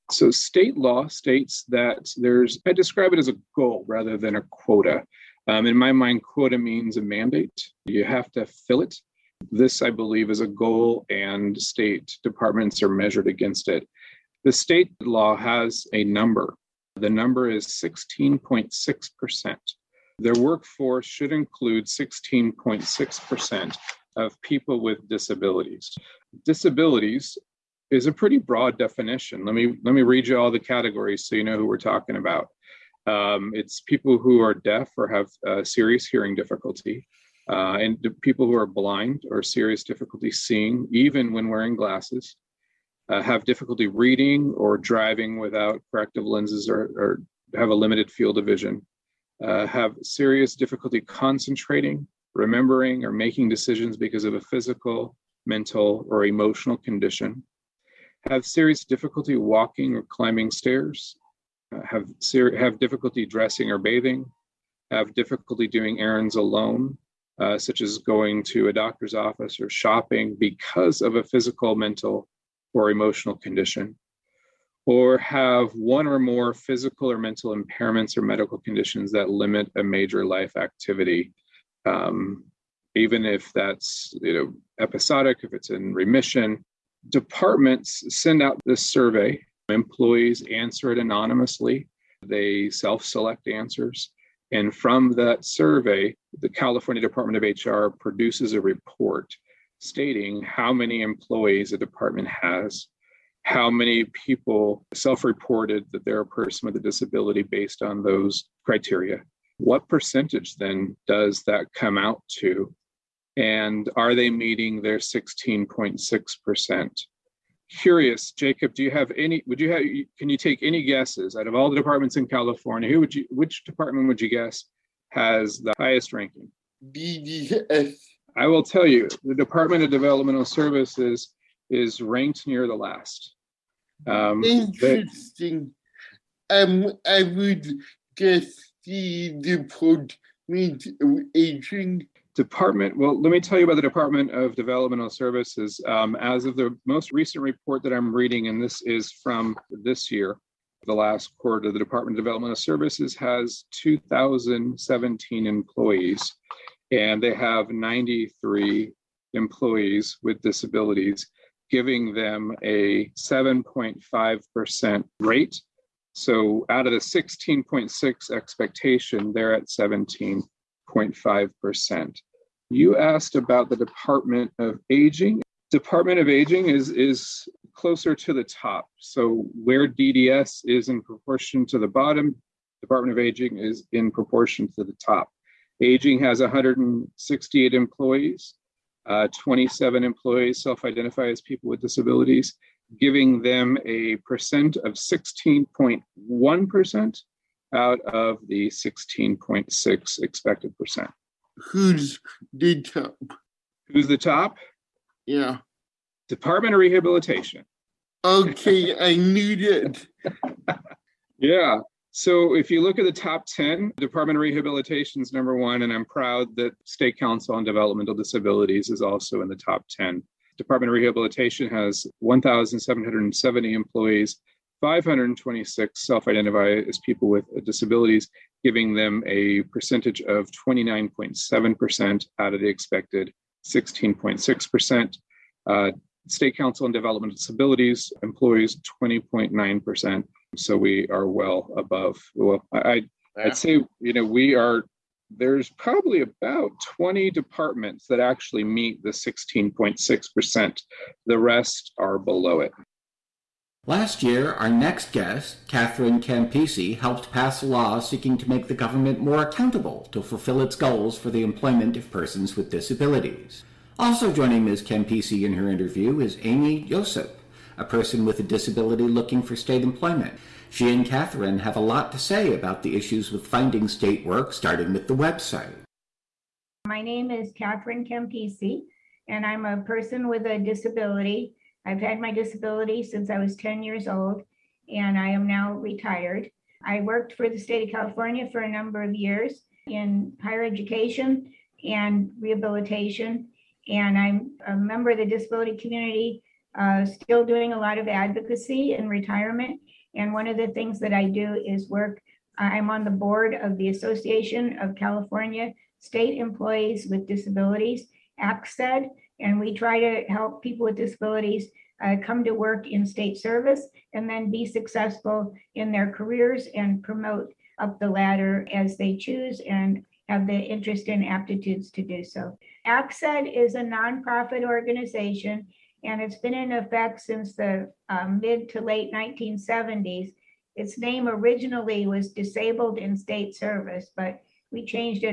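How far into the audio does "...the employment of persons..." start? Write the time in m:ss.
4:21.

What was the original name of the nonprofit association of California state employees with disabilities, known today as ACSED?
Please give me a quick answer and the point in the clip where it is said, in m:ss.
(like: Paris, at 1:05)
Disabled in State Service, at 5:32.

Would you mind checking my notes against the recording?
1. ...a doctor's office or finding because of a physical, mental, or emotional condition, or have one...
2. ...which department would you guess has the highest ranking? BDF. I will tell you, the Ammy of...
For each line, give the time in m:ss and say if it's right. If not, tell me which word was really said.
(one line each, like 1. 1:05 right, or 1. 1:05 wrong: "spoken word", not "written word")
1. 1:08 wrong: "shopping", not "finding"
2. 2:03 wrong: "Department", not "Ammy".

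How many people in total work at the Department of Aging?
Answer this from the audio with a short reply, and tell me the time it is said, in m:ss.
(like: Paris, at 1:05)
168, at 3:06.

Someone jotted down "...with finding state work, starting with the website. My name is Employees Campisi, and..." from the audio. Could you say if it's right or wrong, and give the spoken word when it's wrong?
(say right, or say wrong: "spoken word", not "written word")
wrong: "Catherine", not "Employees".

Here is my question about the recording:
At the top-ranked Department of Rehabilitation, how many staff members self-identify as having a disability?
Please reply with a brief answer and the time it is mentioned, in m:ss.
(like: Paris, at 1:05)
526, at 3:44.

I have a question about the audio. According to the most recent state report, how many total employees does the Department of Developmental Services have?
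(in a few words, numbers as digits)
2,017.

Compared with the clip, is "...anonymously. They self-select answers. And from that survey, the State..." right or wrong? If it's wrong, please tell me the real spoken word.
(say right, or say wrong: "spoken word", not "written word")
wrong: "California", not "State".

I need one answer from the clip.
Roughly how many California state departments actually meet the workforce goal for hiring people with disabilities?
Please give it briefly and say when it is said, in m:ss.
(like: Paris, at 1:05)
About 20, at 4:06.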